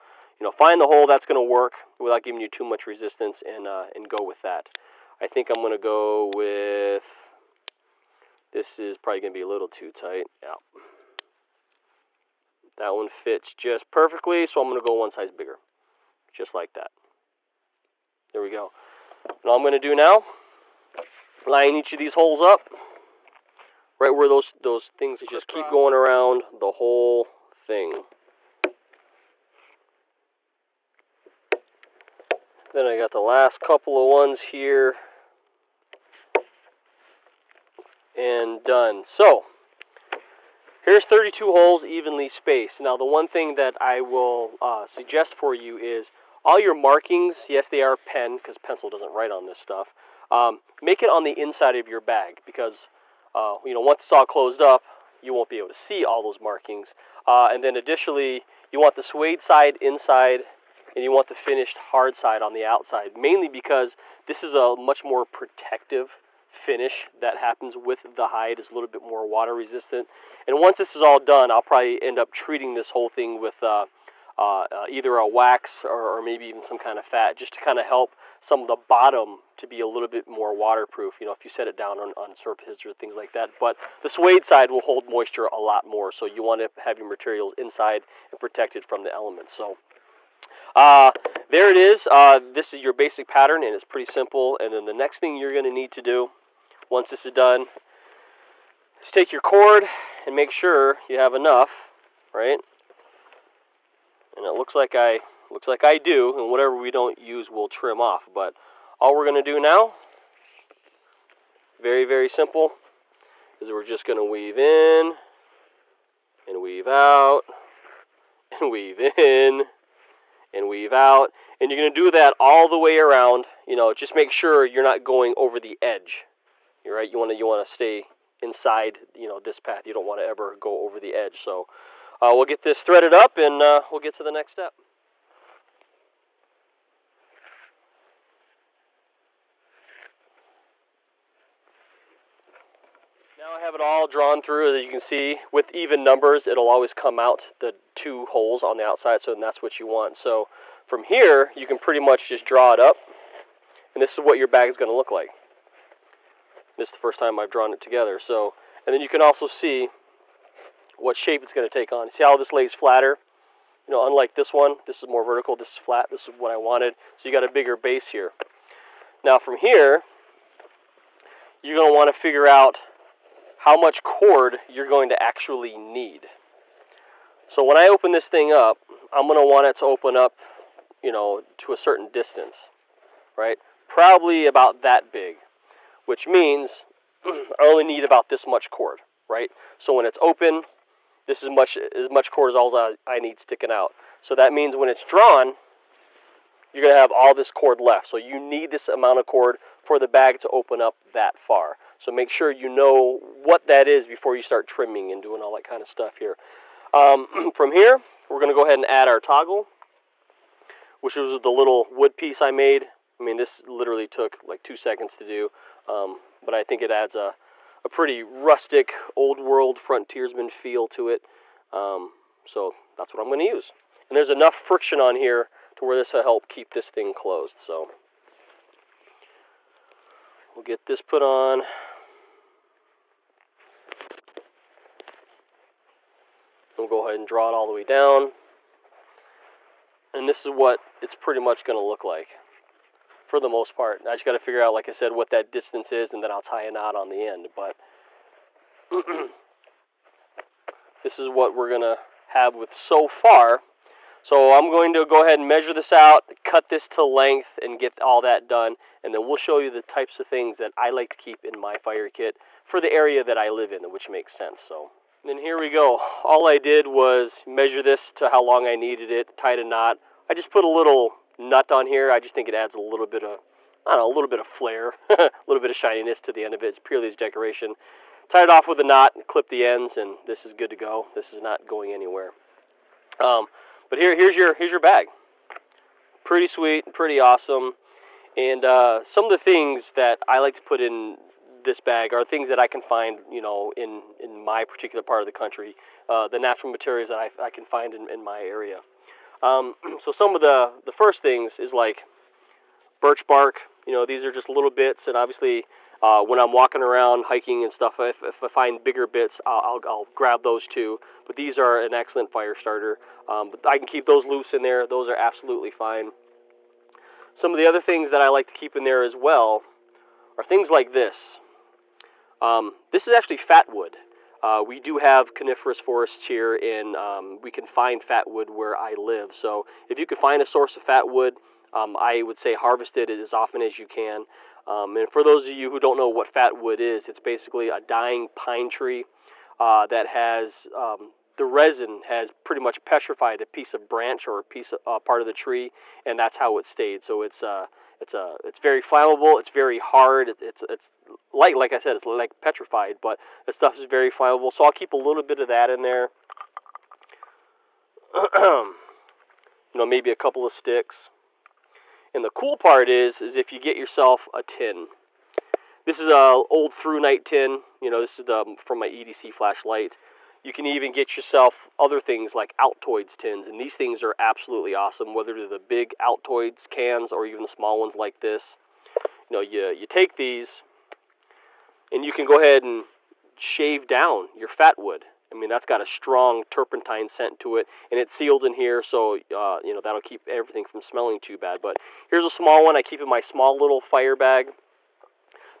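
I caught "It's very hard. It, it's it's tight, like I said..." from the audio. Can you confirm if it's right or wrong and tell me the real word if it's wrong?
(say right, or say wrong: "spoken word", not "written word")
wrong: "light", not "tight".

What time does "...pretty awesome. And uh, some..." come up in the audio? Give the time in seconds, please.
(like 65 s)
286 s.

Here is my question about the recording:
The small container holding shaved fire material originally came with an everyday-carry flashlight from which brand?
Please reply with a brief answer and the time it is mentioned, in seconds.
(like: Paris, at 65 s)
ThruNite, at 366 s.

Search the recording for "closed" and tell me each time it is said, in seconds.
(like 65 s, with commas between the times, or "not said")
54 s, 227 s.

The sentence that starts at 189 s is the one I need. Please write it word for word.
So when it's open, this is much as much cord as all I, I need sticking out.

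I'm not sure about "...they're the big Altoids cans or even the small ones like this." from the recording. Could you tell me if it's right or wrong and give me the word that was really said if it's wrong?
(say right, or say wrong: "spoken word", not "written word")
right.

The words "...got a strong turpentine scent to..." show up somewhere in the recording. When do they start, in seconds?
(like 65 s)
385 s.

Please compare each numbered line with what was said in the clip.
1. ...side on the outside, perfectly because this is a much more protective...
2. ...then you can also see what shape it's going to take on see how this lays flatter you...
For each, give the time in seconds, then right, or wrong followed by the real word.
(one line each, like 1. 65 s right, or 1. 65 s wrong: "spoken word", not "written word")
1. 62 s wrong: "mainly", not "perfectly"
2. 158 s right.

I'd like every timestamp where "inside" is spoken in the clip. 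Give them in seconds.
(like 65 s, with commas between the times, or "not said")
51 s, 59 s, 87 s, 128 s.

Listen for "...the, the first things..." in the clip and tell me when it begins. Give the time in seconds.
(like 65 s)
300 s.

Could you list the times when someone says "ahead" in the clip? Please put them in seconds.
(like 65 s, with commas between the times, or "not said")
208 s, 237 s, 255 s, 382 s.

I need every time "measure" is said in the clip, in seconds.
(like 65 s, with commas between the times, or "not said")
255 s, 267 s.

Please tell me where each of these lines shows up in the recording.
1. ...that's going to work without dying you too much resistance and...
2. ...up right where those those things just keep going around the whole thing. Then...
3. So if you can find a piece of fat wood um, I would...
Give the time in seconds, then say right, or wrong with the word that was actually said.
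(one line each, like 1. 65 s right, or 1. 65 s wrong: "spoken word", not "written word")
1. 1 s wrong: "giving", not "dying"
2. 22 s right
3. 329 s wrong: "source", not "piece".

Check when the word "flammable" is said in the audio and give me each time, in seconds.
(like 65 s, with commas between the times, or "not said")
348 s, 354 s.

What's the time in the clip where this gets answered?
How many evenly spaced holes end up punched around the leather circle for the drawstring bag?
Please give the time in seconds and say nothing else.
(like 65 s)
41 s.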